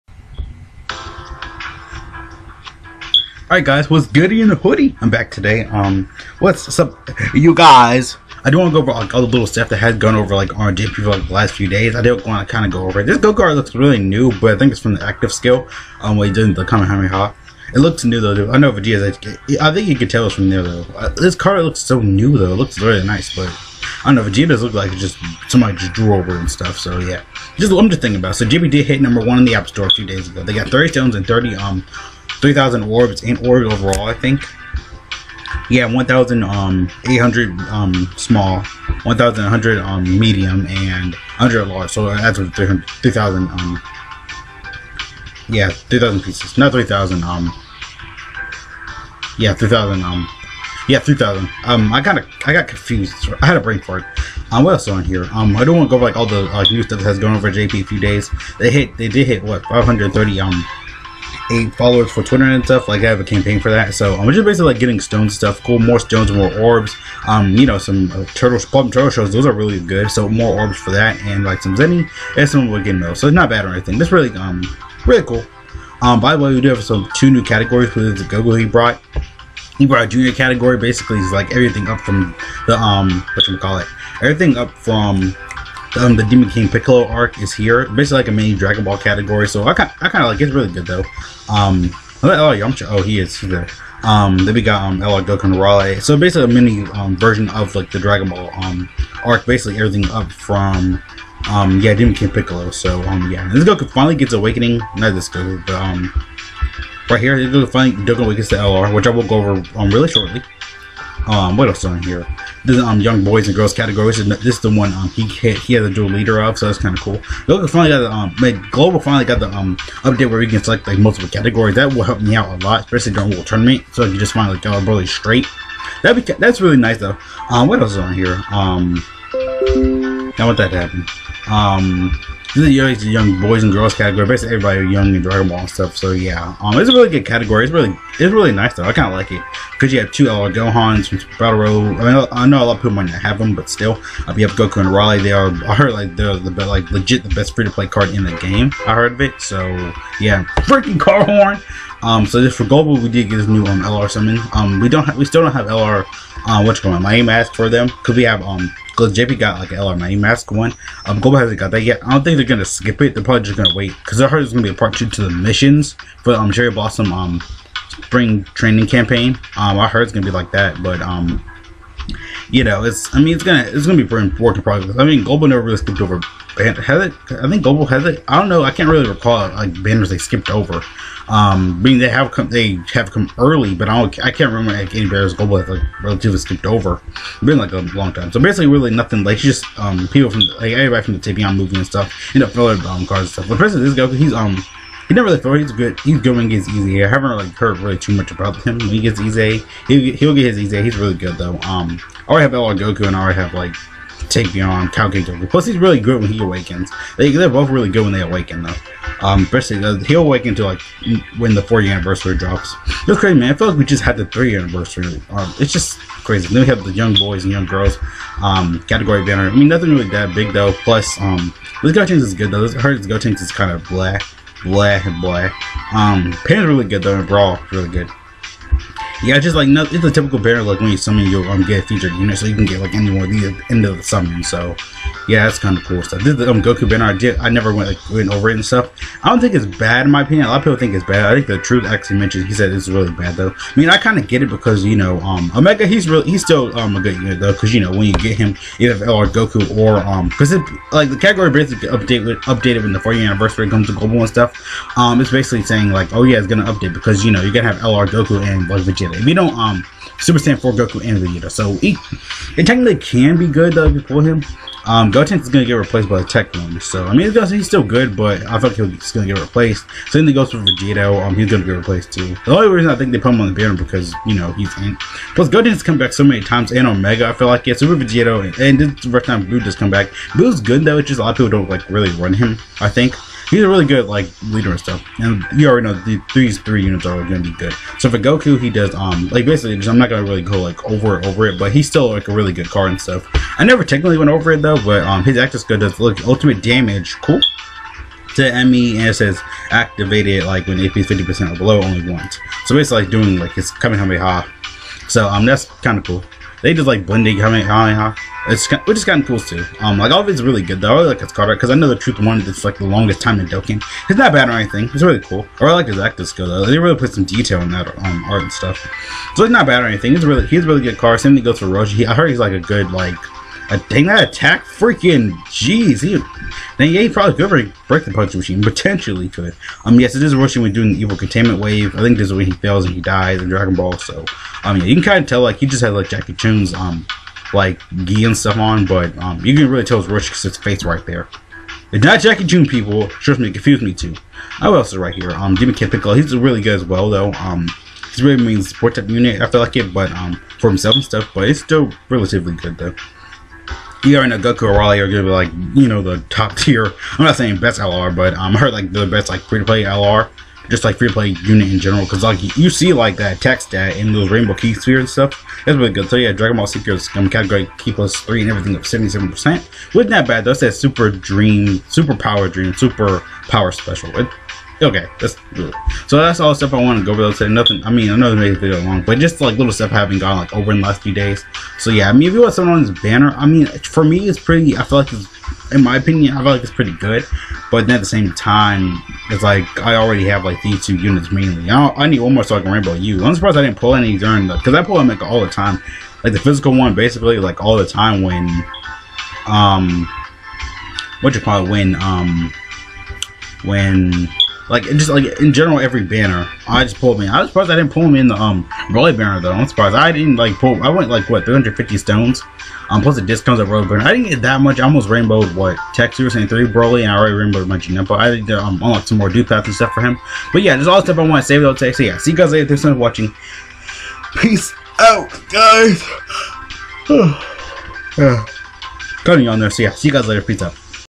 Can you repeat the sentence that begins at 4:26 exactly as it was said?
So I mean, he's, still good, but I think he's gonna get replaced.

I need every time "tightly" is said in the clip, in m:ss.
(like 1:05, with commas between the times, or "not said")
not said.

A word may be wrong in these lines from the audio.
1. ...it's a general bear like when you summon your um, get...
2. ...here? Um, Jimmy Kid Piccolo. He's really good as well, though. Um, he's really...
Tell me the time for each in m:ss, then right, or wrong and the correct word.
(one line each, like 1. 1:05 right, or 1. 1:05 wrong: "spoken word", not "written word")
1. 3:49 wrong: "typical", not "general"
2. 5:45 right.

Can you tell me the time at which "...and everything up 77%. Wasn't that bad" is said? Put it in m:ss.
6:08.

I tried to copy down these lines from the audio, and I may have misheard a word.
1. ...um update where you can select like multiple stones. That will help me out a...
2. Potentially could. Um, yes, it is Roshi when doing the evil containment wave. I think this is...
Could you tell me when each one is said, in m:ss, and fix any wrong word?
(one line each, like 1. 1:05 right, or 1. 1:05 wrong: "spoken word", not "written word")
1. 1:59 wrong: "categories", not "stones"
2. 5:28 right.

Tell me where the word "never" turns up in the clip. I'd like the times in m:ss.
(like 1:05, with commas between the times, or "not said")
2:55, 3:15, 3:57, 4:53.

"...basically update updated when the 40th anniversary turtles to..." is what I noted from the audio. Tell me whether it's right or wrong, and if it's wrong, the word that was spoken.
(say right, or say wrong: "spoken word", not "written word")
wrong: "comes", not "turtles".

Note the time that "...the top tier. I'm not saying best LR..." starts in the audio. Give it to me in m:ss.
5:56.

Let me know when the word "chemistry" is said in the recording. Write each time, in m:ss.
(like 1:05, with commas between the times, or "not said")
not said.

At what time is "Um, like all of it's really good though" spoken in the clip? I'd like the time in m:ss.
5:09.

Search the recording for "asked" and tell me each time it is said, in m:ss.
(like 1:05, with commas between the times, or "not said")
2:37.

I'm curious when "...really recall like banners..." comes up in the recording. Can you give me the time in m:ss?
2:58.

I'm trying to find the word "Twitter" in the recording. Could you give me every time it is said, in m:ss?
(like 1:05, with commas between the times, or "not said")
1:02.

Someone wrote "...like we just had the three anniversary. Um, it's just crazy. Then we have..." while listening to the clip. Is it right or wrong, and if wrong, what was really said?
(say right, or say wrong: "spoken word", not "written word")
right.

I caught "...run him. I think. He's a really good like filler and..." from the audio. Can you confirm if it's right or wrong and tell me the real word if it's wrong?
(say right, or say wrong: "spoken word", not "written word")
wrong: "leader", not "filler".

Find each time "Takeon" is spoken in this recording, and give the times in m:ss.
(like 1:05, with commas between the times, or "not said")
3:24.